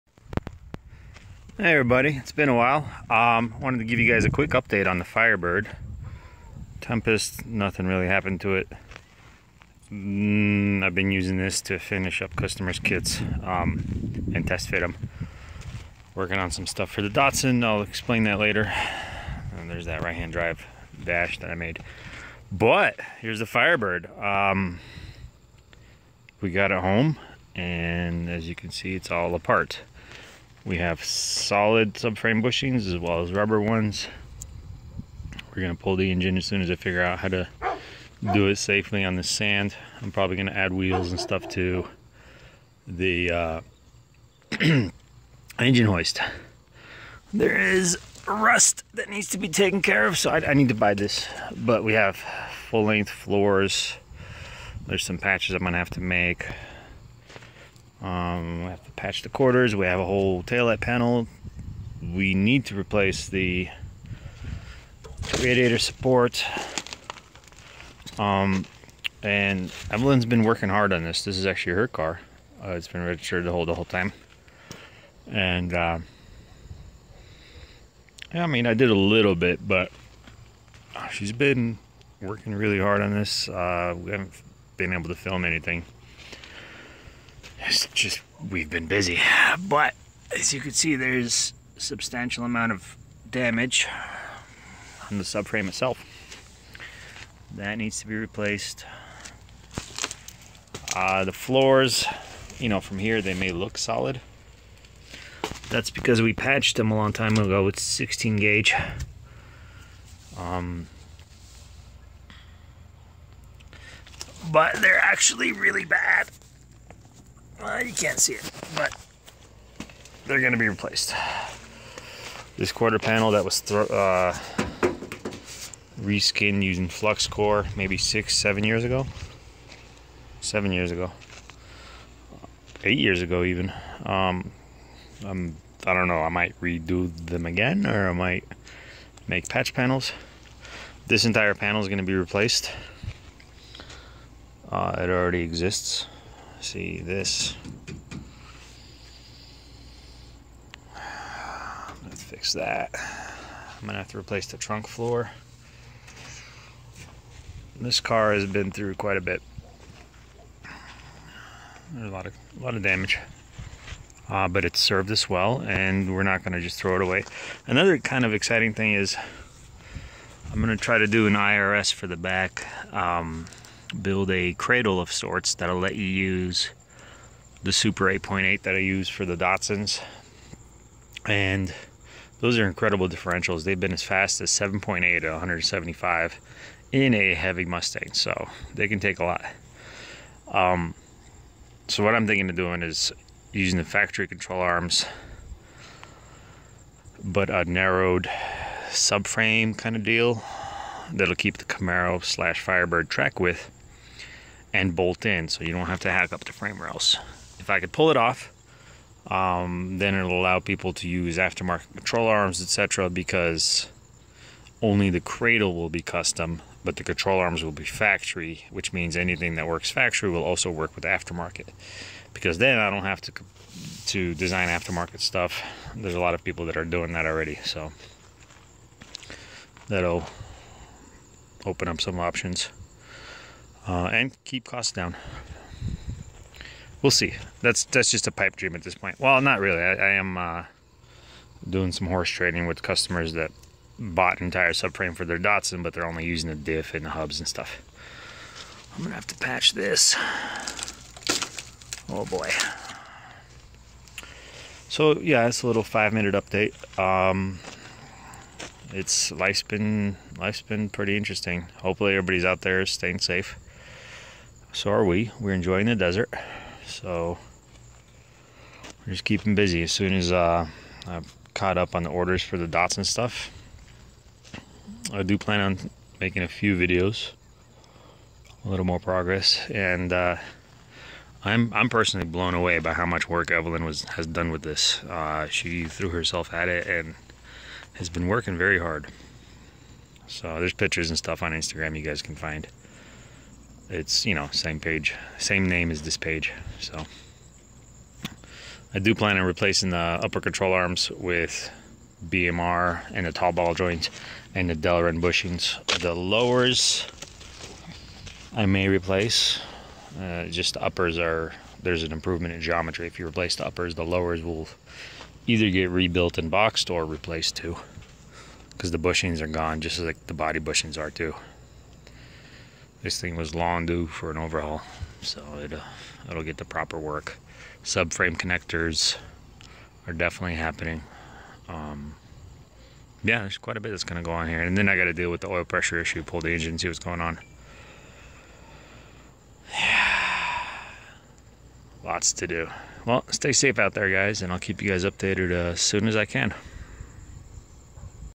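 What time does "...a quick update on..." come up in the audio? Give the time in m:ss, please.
0:04.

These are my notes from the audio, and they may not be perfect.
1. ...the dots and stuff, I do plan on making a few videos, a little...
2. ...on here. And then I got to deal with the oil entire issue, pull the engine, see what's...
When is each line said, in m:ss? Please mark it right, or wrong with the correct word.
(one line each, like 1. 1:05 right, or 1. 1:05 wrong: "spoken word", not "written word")
1. 4:32 right
2. 5:34 wrong: "pressure", not "entire".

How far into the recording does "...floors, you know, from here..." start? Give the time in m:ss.
1:41.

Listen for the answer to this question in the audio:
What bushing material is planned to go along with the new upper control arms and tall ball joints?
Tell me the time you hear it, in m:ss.
5:04.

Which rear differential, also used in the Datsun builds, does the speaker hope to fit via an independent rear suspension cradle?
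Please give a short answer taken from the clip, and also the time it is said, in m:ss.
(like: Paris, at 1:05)
Super 8.8, at 2:57.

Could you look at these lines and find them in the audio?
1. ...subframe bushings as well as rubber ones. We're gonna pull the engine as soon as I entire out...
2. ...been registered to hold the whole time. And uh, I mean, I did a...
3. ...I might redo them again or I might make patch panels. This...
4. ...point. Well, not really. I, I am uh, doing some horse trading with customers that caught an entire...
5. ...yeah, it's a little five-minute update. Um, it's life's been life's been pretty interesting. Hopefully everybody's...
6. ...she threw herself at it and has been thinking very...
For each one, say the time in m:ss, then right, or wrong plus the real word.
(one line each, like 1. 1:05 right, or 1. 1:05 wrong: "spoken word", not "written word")
1. 0:31 wrong: "figure", not "entire"
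2. 1:12 right
3. 2:16 right
4. 3:58 wrong: "bought", not "caught"
5. 4:15 right
6. 4:45 wrong: "working", not "thinking".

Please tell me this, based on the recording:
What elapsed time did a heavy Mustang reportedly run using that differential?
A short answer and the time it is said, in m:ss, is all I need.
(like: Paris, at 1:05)
7.8, at 3:04.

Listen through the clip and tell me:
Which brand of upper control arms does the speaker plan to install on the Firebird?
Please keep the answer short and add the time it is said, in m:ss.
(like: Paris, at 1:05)
BMR, at 5:02.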